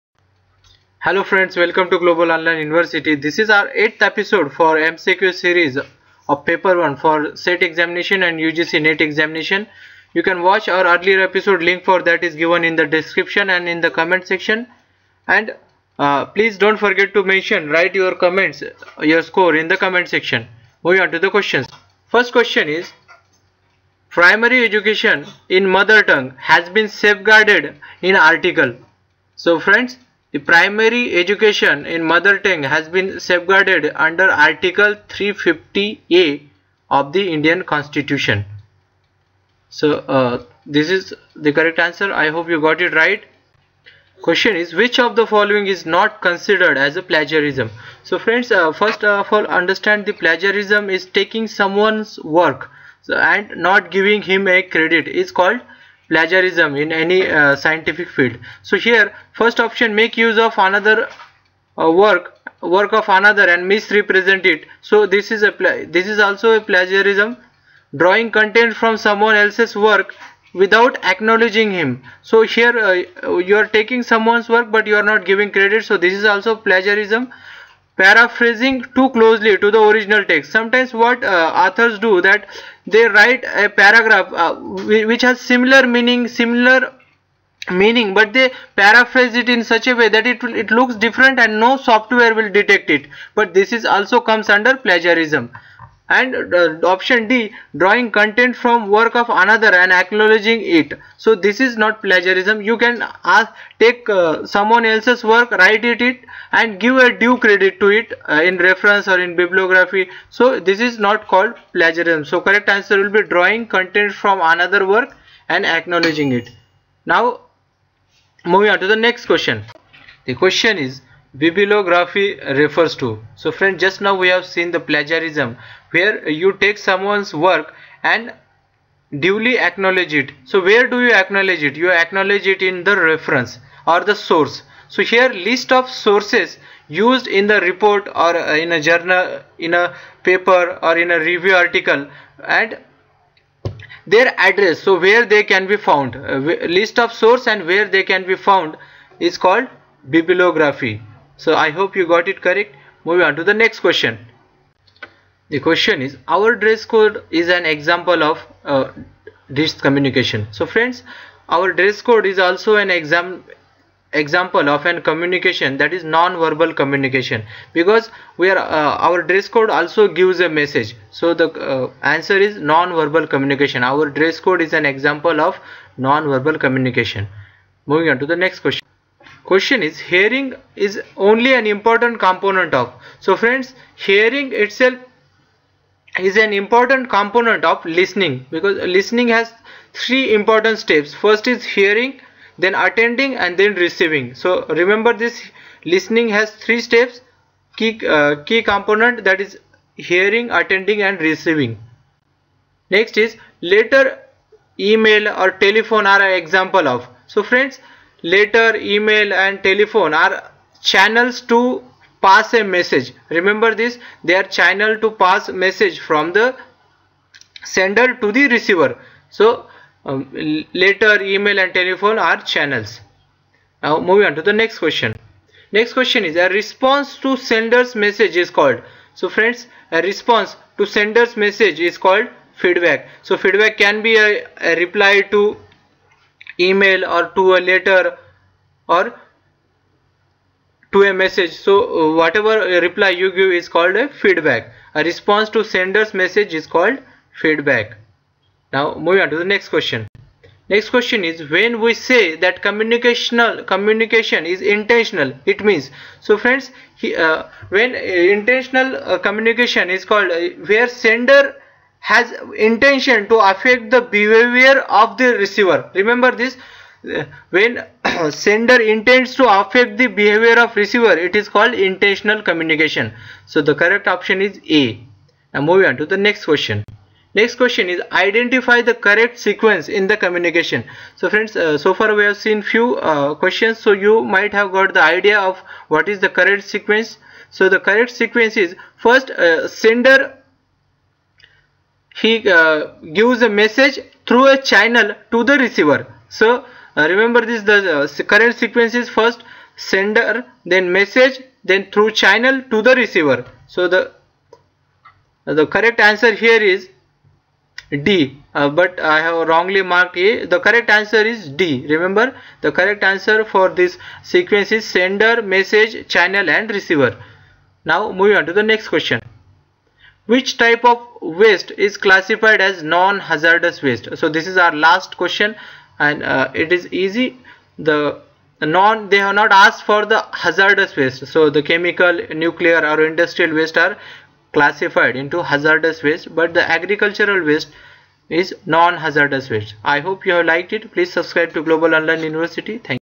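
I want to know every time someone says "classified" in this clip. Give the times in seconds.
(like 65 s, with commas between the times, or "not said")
322 s, 334 s.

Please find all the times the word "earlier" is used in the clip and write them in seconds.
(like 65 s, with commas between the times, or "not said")
10 s.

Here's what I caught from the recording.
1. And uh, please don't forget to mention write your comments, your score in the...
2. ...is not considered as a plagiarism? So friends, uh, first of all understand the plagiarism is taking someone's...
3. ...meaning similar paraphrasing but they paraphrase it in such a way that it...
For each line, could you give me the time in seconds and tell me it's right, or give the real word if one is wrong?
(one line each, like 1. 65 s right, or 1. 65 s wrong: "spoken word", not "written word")
1. 15 s right
2. 45 s right
3. 85 s wrong: "meaning", not "paraphrasing".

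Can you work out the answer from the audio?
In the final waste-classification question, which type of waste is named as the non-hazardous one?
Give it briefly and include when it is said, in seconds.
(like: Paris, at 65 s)
agricultural waste, at 336 s.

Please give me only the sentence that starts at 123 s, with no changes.
So friend just now we have seen the plagiarism where you take someone's work and duly acknowledge it.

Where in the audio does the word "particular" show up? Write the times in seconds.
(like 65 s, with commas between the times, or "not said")
not said.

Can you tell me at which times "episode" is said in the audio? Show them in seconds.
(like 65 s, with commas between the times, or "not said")
4 s, 11 s.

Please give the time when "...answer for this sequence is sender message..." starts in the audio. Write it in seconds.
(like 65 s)
313 s.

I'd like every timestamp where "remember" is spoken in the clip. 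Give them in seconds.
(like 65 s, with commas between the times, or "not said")
194 s, 213 s, 265 s, 297 s, 311 s.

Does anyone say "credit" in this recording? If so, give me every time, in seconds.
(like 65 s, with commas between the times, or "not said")
54 s, 75 s, 107 s.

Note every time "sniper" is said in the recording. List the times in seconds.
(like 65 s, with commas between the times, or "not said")
not said.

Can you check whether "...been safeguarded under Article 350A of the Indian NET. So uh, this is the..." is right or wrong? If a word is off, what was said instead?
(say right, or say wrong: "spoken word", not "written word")
wrong: "Constitution", not "NET".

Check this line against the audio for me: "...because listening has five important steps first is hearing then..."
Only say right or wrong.
wrong.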